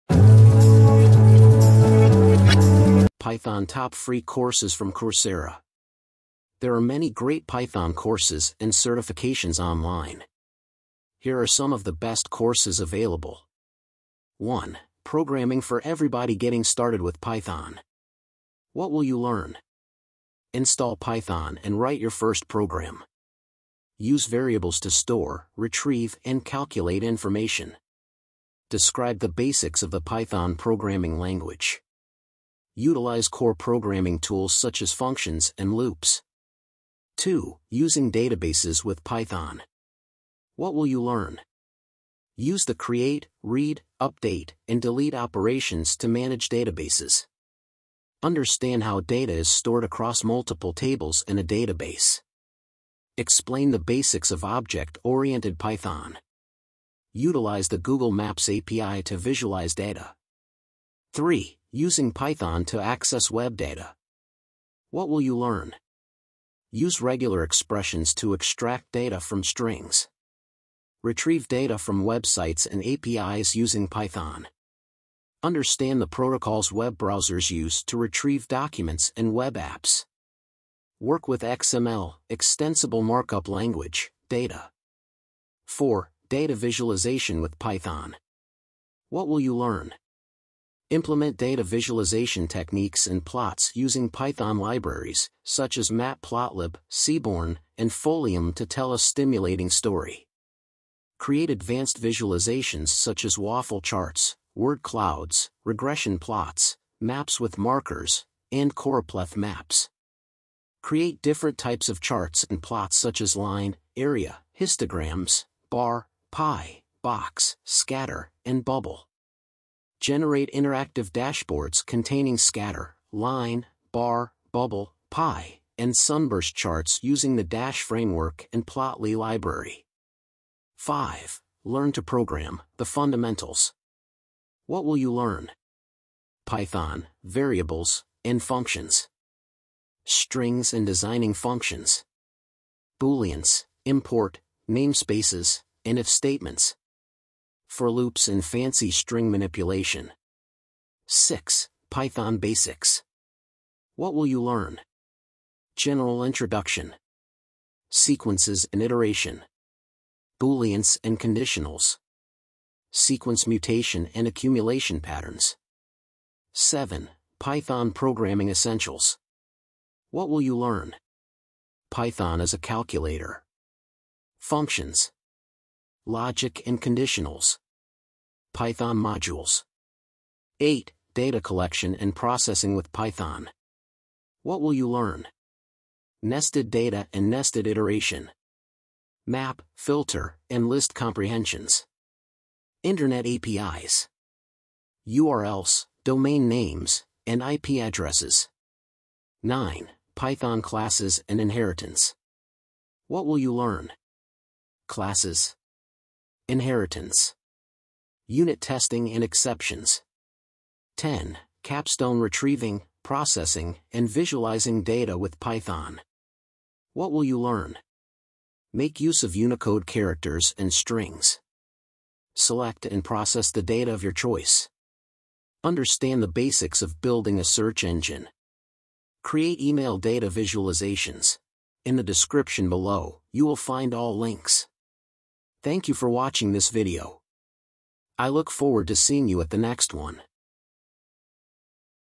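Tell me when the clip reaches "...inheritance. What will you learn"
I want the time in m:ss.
3:21.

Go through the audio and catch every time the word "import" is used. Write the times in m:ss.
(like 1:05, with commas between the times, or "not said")
2:23.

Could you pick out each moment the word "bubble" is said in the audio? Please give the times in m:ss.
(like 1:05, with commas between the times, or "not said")
1:58, 2:04.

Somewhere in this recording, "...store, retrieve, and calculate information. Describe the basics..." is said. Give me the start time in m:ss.
0:24.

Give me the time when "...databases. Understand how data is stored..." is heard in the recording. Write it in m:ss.
0:46.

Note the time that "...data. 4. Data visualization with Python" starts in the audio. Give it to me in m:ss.
1:24.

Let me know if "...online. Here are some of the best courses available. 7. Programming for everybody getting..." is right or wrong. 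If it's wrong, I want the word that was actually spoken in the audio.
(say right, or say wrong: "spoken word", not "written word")
wrong: "1", not "7".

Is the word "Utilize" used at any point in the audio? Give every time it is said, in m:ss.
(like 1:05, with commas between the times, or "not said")
0:32, 0:57.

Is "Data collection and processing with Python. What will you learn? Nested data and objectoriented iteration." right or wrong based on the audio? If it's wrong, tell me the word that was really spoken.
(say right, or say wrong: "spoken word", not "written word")
wrong: "nested", not "objectoriented".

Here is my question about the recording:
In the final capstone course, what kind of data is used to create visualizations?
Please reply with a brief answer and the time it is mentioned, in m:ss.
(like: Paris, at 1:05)
email data, at 3:49.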